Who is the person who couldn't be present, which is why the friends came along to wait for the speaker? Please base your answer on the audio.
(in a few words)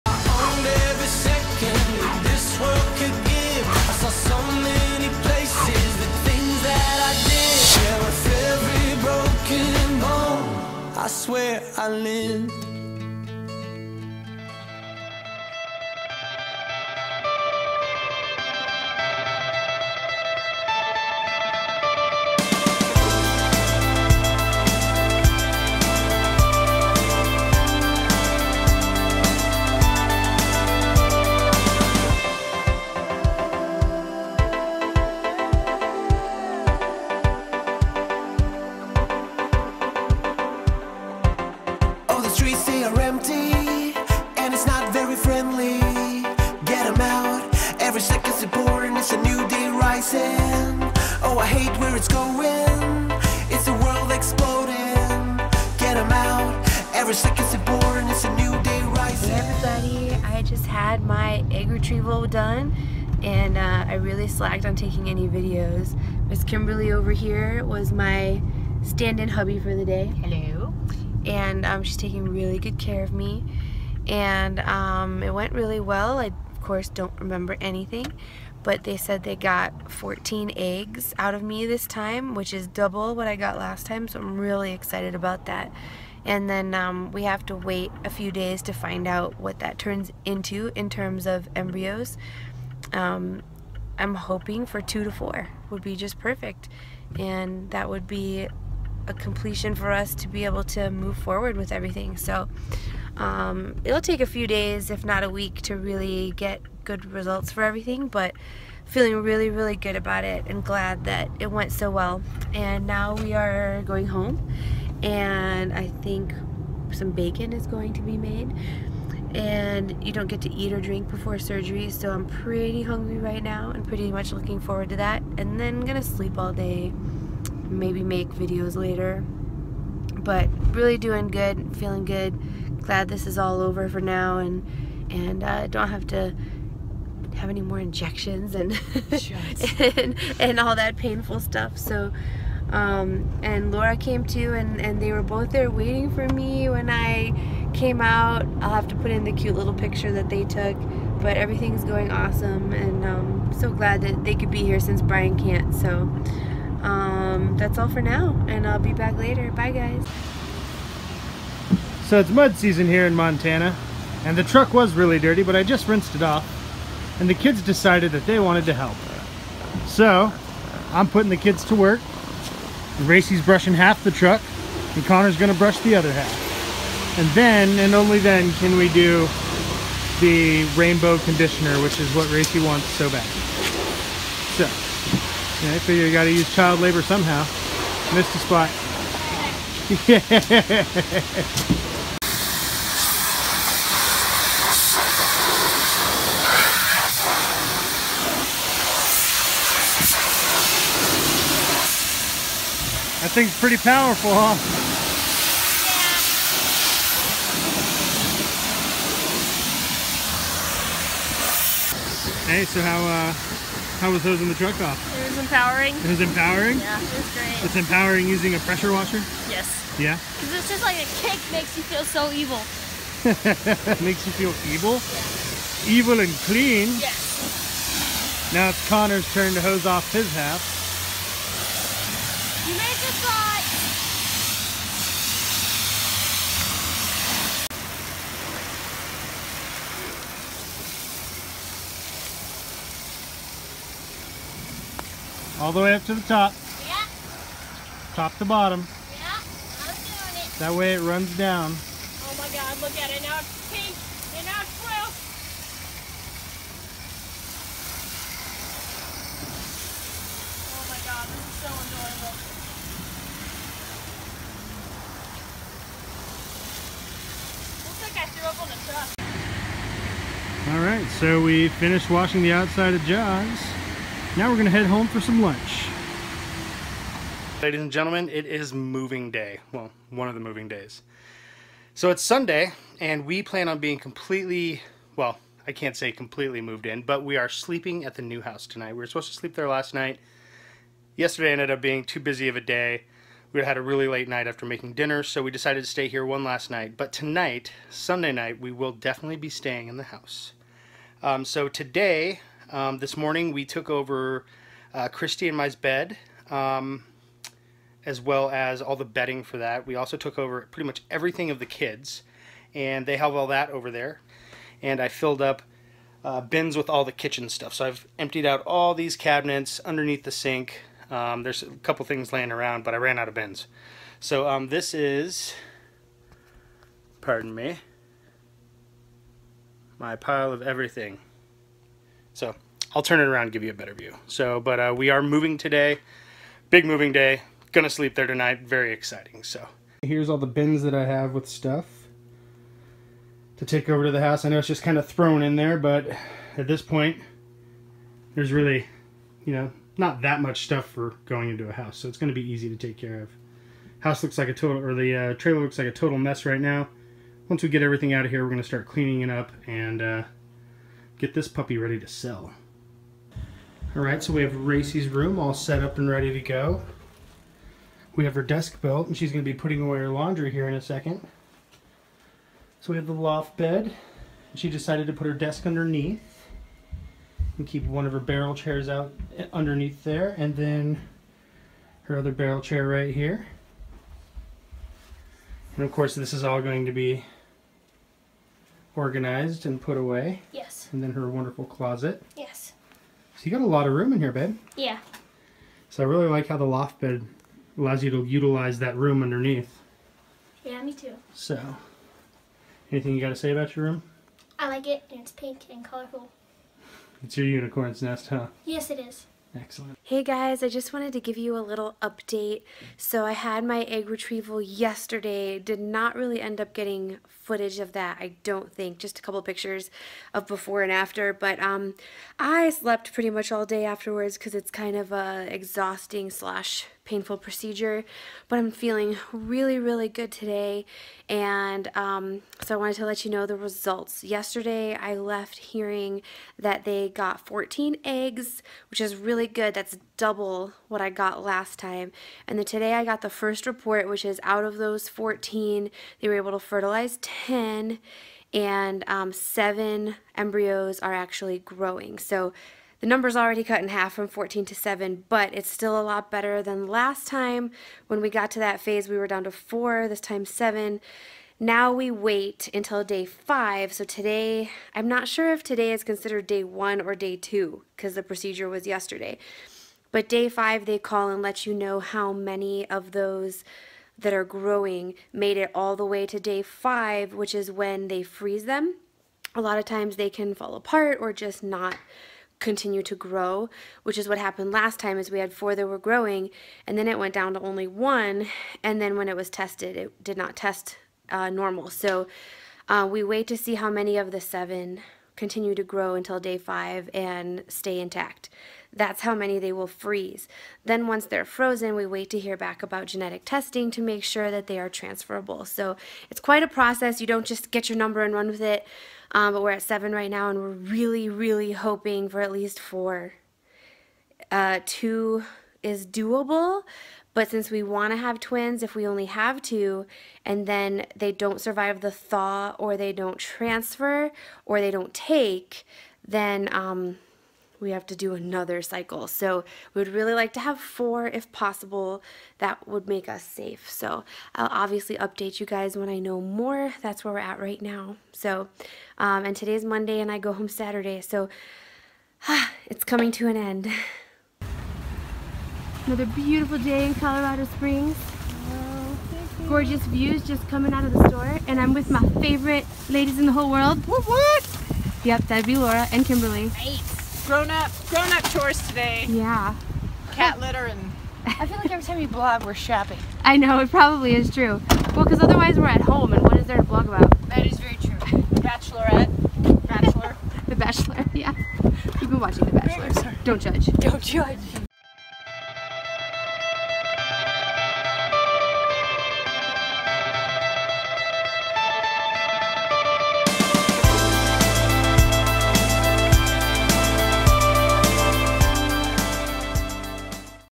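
Brian.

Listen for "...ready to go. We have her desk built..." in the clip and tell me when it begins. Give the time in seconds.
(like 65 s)
366 s.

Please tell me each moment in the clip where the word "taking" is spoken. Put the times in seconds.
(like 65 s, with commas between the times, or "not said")
64 s, 71 s.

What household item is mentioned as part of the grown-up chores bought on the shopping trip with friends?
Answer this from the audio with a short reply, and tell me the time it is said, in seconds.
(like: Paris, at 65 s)
cat litter, at 560 s.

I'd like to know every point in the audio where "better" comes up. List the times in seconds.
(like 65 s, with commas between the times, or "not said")
333 s, 456 s.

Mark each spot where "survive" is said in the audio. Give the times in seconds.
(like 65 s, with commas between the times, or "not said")
521 s.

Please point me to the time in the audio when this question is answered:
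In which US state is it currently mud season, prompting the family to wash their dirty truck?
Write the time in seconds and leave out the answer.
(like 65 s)
163 s.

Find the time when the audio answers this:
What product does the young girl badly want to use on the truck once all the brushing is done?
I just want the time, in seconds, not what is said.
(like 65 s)
180 s.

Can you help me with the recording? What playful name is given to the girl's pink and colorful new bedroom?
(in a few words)
unicorn's nest.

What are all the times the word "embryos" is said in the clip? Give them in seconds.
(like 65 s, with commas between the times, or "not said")
91 s, 450 s.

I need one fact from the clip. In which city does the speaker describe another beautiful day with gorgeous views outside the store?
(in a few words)
Colorado Springs.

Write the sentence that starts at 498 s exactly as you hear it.
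That's how many they will freeze.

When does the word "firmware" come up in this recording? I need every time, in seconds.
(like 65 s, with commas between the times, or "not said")
not said.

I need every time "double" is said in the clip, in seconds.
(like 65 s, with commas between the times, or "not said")
82 s, 440 s.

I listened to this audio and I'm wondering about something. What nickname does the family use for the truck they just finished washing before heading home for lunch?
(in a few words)
Jaws.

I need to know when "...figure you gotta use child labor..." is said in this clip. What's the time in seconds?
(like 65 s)
185 s.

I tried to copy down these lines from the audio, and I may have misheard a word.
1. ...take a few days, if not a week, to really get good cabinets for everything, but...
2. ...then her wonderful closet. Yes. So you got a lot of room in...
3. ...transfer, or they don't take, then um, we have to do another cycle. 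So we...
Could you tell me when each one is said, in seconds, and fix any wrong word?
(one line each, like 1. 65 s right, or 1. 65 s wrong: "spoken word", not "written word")
1. 104 s wrong: "results", not "cabinets"
2. 391 s right
3. 523 s right.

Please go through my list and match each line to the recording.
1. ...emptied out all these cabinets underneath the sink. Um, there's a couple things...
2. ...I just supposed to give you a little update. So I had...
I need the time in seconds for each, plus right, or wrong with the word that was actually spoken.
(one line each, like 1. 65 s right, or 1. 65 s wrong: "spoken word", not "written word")
1. 318 s right
2. 410 s wrong: "wanted", not "supposed".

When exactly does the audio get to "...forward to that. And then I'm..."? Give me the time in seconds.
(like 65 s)
124 s.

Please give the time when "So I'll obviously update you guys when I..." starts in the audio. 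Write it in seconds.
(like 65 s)
533 s.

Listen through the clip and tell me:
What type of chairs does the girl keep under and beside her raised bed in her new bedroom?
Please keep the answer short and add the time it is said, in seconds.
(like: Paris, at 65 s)
barrel chairs, at 378 s.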